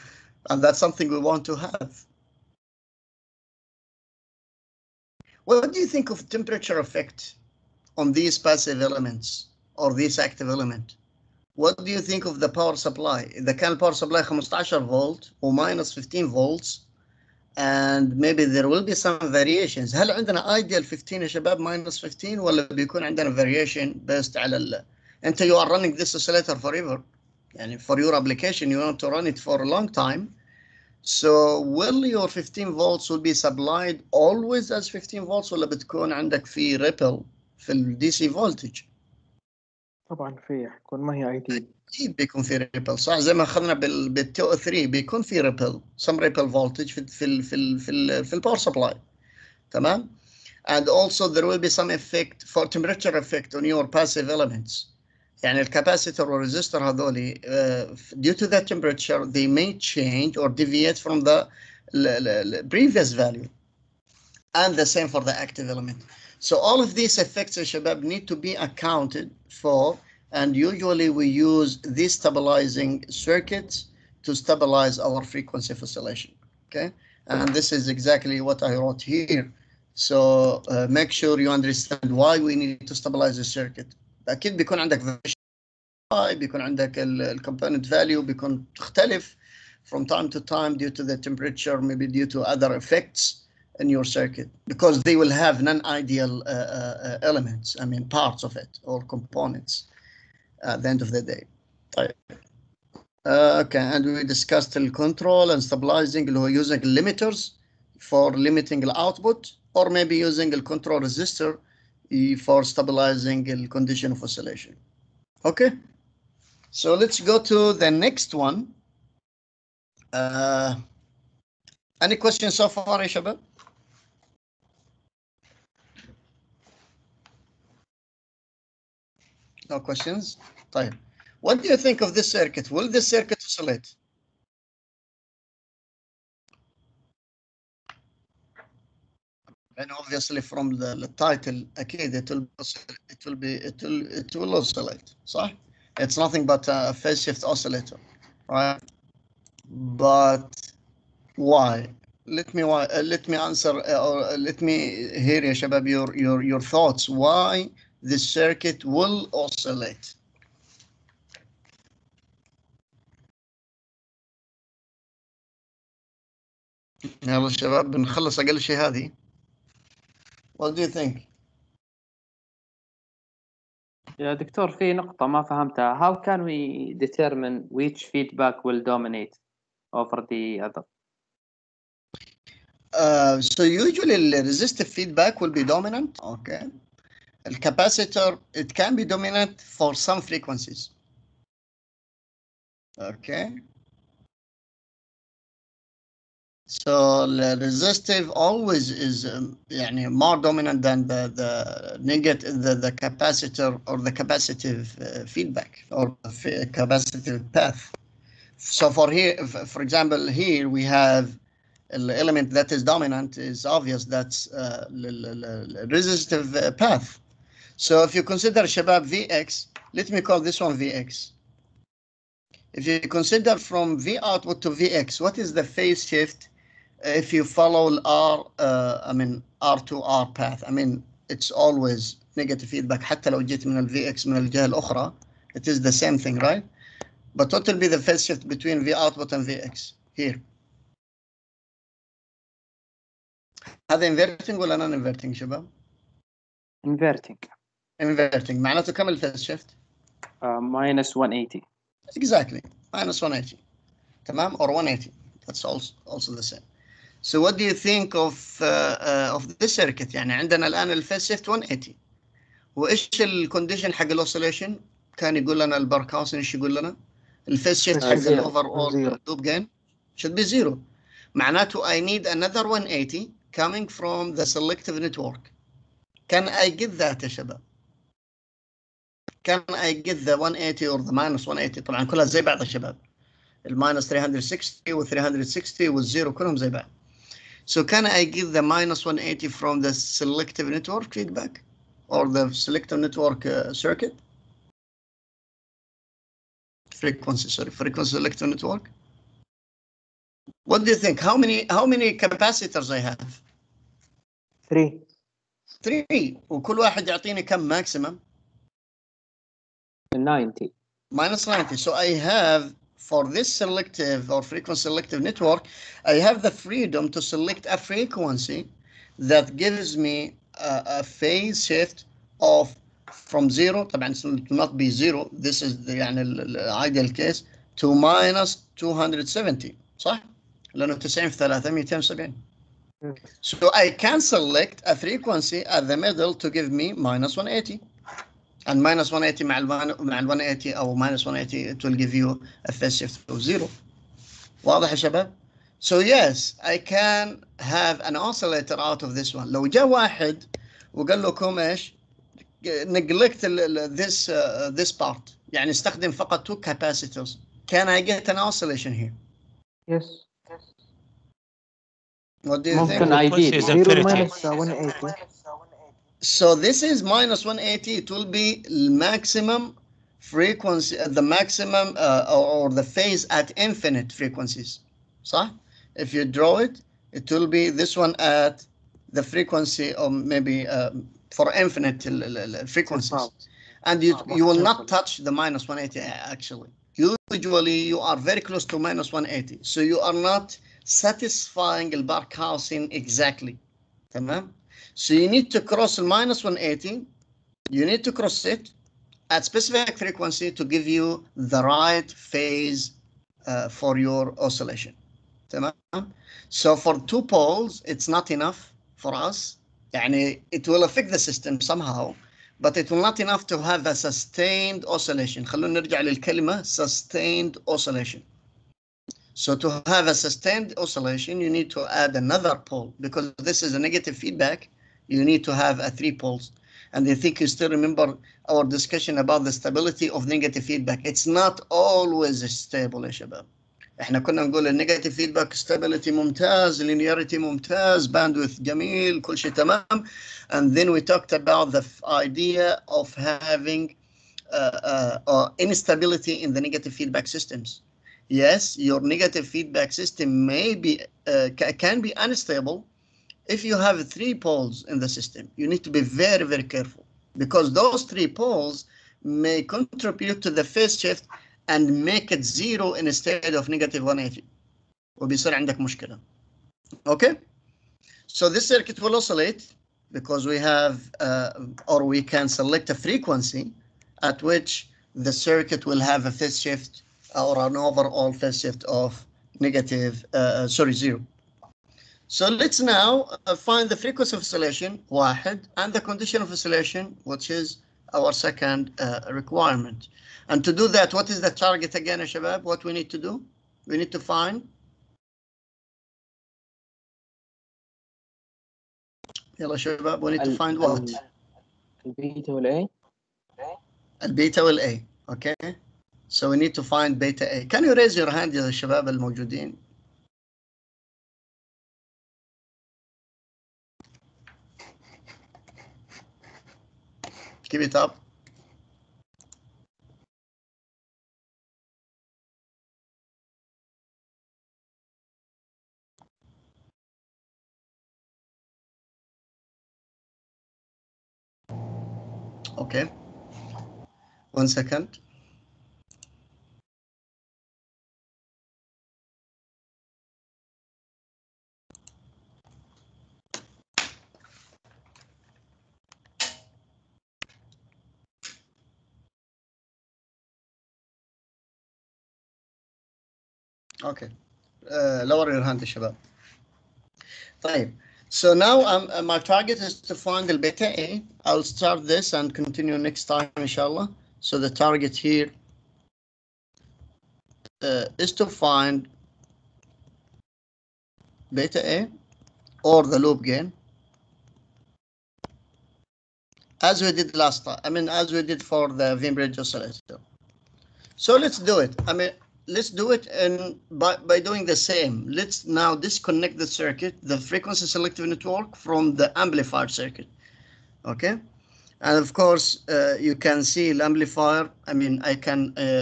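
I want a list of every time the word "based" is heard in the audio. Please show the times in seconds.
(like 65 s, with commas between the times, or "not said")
24 s.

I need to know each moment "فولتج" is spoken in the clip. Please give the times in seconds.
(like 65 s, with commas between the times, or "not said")
38 s, 46 s.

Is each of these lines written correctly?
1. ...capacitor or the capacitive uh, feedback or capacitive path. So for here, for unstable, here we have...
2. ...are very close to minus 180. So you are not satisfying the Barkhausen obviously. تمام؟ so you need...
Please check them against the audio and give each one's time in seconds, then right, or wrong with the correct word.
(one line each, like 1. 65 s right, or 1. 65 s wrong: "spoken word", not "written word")
1. 202 s wrong: "example", not "unstable"
2. 387 s wrong: "exactly", not "obviously".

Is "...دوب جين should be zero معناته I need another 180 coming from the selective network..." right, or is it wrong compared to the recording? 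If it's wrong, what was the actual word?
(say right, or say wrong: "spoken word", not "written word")
right.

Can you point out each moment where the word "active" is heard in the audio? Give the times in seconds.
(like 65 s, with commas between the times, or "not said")
10 s, 65 s.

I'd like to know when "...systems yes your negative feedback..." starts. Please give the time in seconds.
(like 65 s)
447 s.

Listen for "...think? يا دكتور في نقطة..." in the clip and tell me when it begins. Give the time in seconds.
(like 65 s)
170 s.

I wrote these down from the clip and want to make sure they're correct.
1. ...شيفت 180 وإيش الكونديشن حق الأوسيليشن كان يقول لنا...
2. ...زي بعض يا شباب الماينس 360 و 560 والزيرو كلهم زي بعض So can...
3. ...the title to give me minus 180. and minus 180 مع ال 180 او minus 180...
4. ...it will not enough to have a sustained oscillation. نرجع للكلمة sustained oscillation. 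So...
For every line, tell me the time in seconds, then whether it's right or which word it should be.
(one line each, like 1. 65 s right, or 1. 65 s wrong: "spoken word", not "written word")
1. 261 s right
2. 282 s wrong: "360", not "560"
3. 335 s wrong: "middle", not "title"
4. 412 s right.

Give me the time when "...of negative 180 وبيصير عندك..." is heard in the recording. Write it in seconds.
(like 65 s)
463 s.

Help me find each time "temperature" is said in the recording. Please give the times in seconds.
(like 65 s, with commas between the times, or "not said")
6 s, 52 s, 58 s, 91 s.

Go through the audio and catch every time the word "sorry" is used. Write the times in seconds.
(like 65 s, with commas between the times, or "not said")
297 s, 480 s.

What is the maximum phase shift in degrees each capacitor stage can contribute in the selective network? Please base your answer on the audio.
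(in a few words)
minus 90.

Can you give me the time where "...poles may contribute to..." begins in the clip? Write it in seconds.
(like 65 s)
458 s.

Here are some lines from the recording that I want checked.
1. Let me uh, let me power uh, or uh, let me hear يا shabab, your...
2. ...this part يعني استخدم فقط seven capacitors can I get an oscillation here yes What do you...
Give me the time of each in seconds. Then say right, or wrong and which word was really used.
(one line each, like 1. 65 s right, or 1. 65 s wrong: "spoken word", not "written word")
1. 152 s wrong: "answer", not "power"
2. 354 s wrong: "two", not "seven".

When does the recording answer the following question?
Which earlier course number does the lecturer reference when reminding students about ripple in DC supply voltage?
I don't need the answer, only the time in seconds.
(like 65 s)
44 s.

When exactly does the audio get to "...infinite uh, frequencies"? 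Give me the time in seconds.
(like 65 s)
381 s.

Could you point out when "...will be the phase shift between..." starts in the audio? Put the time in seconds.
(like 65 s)
237 s.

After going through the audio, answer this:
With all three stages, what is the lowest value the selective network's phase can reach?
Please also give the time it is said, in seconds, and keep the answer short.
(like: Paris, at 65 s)
minus 270, at 327 s.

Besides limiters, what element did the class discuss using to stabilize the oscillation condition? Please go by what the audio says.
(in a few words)
control resistor.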